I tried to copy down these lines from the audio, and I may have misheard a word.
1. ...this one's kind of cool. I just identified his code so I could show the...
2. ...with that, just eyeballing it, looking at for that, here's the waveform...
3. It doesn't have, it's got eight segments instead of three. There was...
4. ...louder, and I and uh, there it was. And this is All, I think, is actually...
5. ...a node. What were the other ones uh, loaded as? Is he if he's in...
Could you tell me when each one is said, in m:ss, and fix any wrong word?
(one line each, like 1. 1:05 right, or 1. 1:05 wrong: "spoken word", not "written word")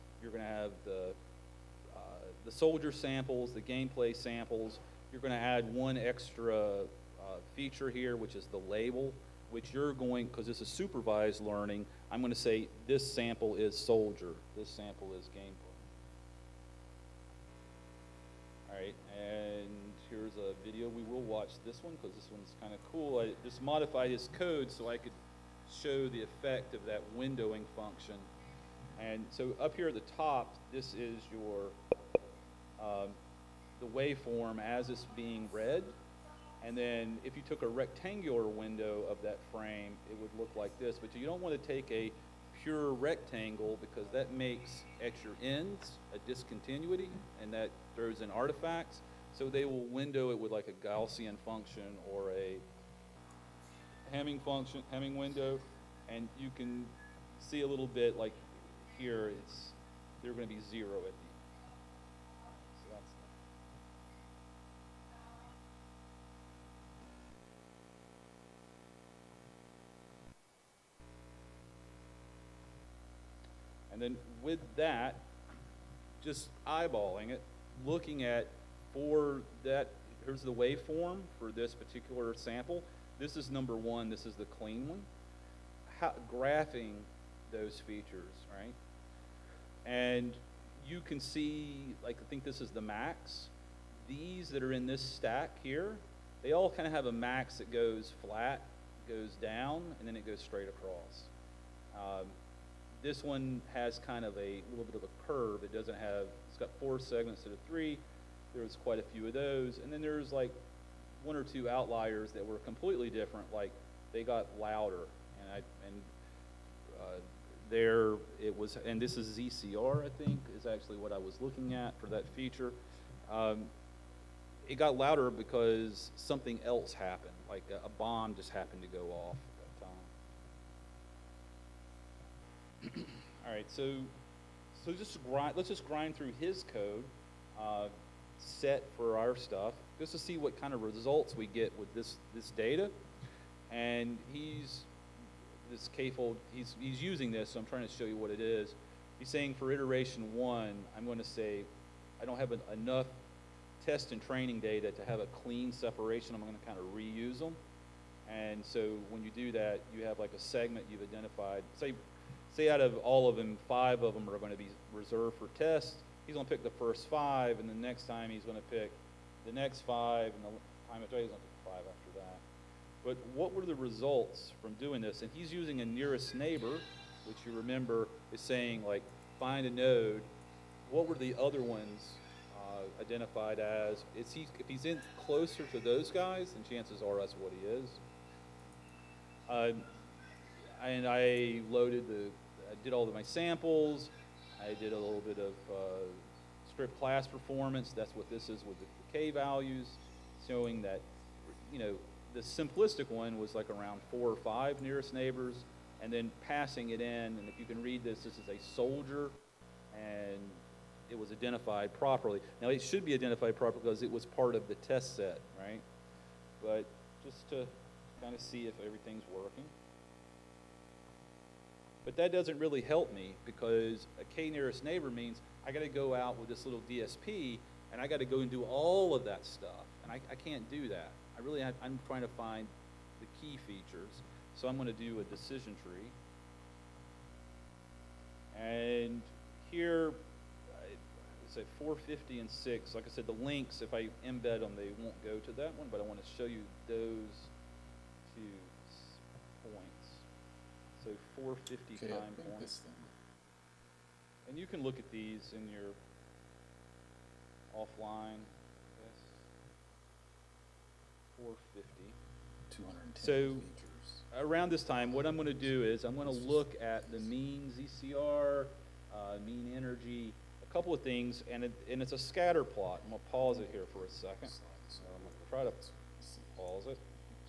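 1. 0:22 wrong: "modified", not "identified"
2. 1:14 right
3. 1:45 wrong: "four", not "eight"
4. 1:54 wrong: "ZCR", not "All"
5. 2:59 wrong: "identified", not "loaded".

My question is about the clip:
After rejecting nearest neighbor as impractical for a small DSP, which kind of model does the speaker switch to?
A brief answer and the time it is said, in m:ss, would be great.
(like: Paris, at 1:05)
Decision tree, at 3:55.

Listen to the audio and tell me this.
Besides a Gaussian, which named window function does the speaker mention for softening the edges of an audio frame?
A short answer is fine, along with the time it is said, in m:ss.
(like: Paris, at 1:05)
Hamming window, at 0:54.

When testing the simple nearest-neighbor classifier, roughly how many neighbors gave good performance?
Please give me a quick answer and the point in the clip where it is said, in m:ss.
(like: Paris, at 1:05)
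4 or 5, at 3:24.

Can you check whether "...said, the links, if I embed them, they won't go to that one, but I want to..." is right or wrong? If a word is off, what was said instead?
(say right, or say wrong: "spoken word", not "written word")
right.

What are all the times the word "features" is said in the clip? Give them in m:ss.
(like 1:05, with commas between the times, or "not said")
0:07, 1:27, 2:02, 3:53, 4:23.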